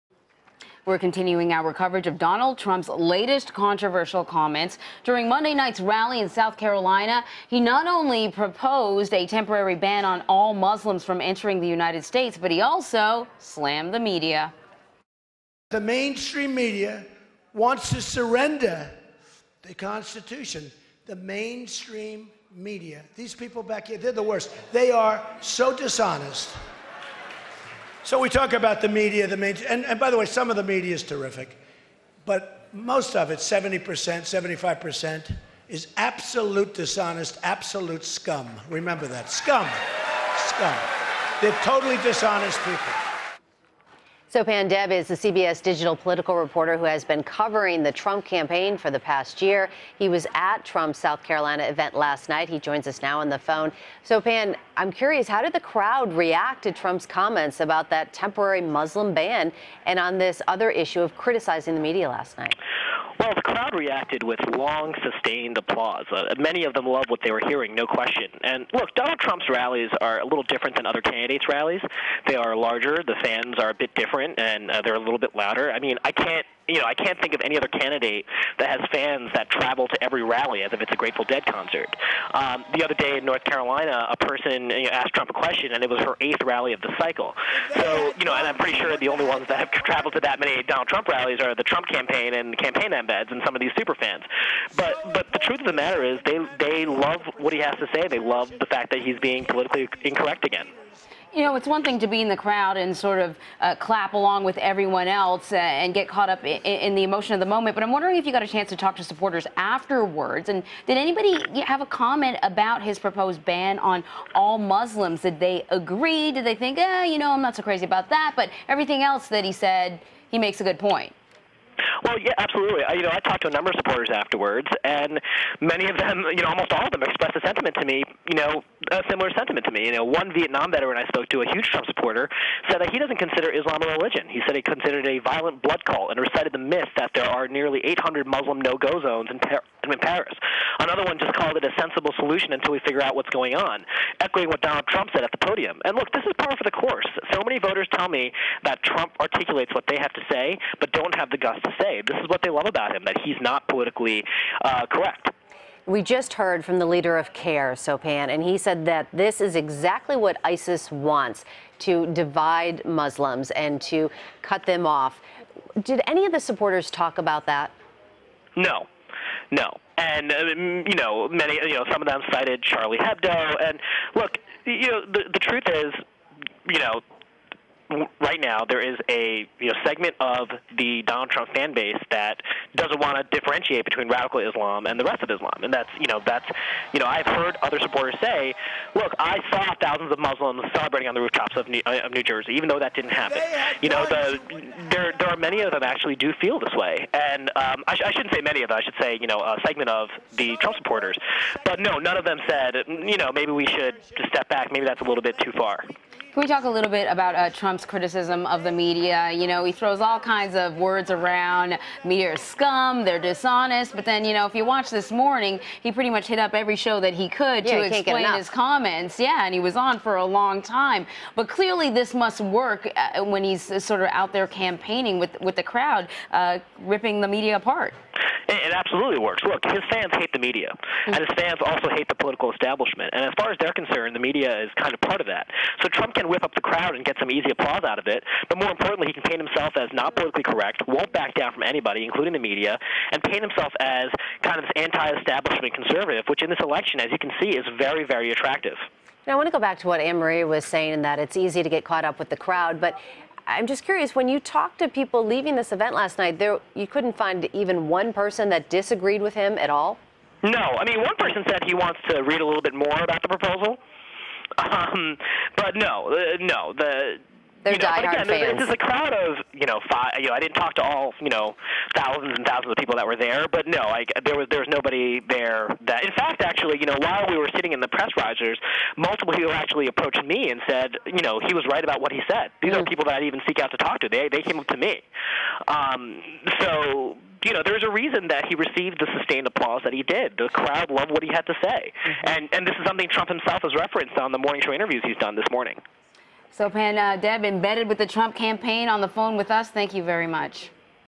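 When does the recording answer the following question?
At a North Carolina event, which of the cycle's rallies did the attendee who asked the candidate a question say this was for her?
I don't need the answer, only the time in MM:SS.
01:26.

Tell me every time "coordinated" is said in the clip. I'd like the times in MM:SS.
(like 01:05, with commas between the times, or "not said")
not said.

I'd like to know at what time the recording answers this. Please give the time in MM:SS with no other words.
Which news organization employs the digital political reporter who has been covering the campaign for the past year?
00:45.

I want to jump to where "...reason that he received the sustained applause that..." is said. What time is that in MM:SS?
04:47.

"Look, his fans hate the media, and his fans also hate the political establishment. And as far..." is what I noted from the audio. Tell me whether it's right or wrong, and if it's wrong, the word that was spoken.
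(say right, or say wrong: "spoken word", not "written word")
right.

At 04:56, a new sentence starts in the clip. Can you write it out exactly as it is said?
Sopan uh, Deb, embedded with the Trump campaign on the phone with us, thank you very much.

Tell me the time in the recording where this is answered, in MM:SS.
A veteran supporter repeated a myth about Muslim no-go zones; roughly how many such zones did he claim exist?
02:17.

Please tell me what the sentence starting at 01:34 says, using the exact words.
But but the truth of the matter is they they love what he has to say.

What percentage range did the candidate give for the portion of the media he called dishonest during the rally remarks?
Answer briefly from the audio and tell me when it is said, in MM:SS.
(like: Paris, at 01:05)
70%, 75%, at 00:33.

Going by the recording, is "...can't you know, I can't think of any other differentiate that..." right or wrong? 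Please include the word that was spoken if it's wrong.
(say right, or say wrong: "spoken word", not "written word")
wrong: "candidate", not "differentiate".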